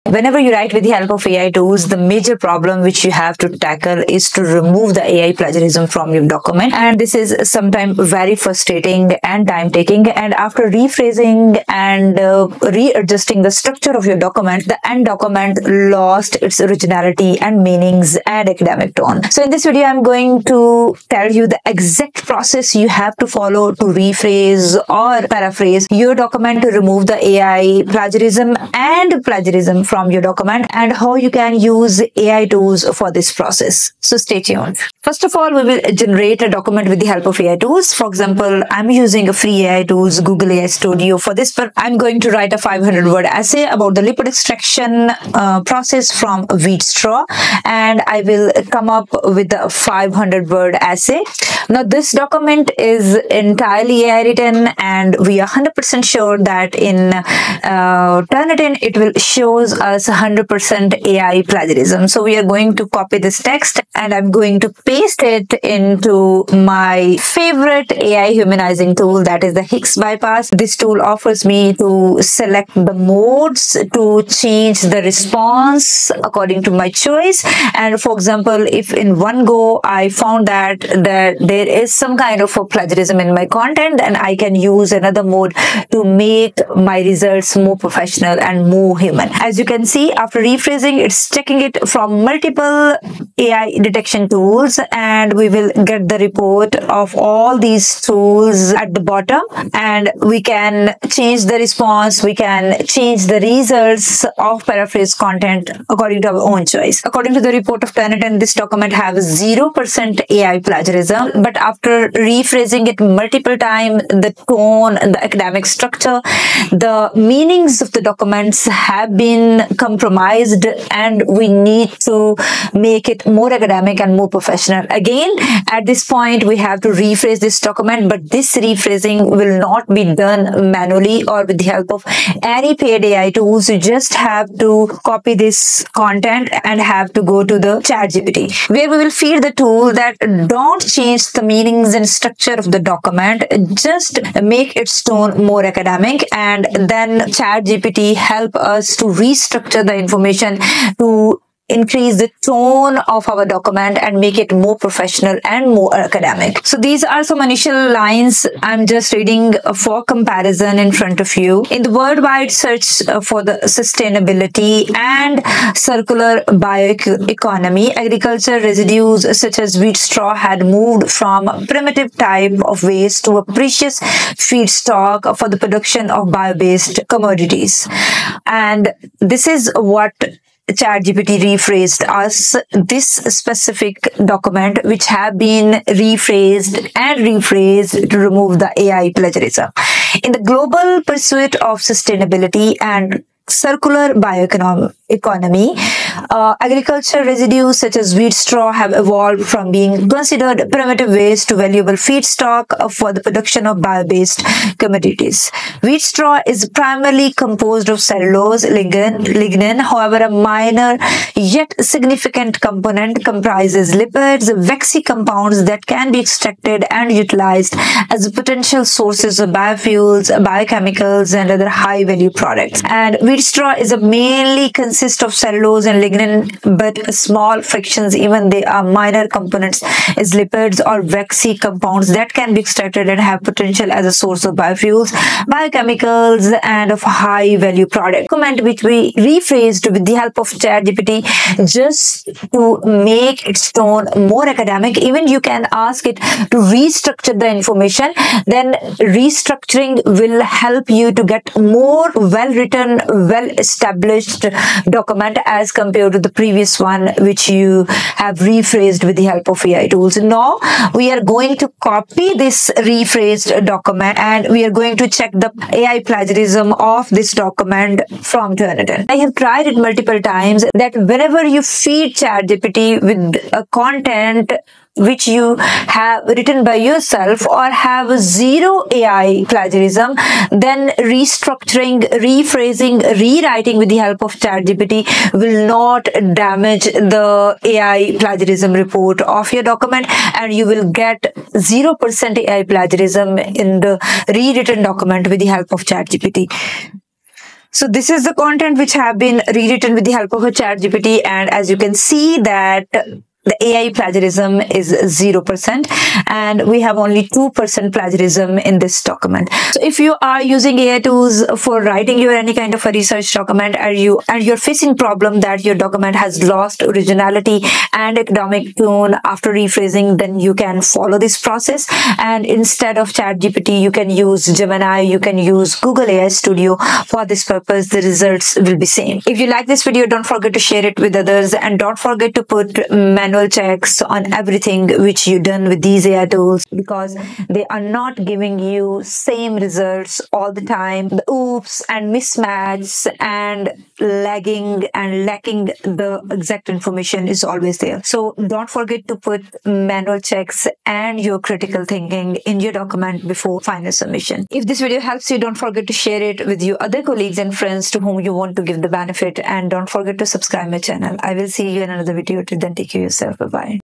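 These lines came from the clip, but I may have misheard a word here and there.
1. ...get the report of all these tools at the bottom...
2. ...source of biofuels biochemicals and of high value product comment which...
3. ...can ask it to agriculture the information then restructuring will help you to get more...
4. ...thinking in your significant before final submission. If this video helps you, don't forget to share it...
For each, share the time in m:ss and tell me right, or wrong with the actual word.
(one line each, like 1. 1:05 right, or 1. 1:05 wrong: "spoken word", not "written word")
1. 1:35 right
2. 3:54 right
3. 4:05 wrong: "restructure", not "agriculture"
4. 5:51 wrong: "document", not "significant".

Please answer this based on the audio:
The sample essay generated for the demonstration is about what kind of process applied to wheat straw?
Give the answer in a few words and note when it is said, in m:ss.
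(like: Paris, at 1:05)
Lipid extraction, at 0:44.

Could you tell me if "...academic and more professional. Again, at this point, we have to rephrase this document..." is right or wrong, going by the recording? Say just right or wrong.
right.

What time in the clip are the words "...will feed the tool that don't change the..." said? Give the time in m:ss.
2:18.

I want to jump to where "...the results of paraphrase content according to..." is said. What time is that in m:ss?
1:43.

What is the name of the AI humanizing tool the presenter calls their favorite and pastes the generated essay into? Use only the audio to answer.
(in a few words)
HIX Bypass.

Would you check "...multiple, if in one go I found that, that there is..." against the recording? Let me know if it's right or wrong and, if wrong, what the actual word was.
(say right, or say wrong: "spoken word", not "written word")
wrong: "example", not "multiple".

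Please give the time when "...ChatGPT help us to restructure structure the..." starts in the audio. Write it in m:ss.
2:27.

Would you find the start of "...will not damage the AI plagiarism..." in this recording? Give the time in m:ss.
4:45.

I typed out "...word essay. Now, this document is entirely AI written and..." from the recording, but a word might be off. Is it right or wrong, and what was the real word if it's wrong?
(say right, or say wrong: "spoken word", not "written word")
right.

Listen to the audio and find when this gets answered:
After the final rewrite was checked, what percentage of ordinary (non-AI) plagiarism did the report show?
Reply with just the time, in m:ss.
5:07.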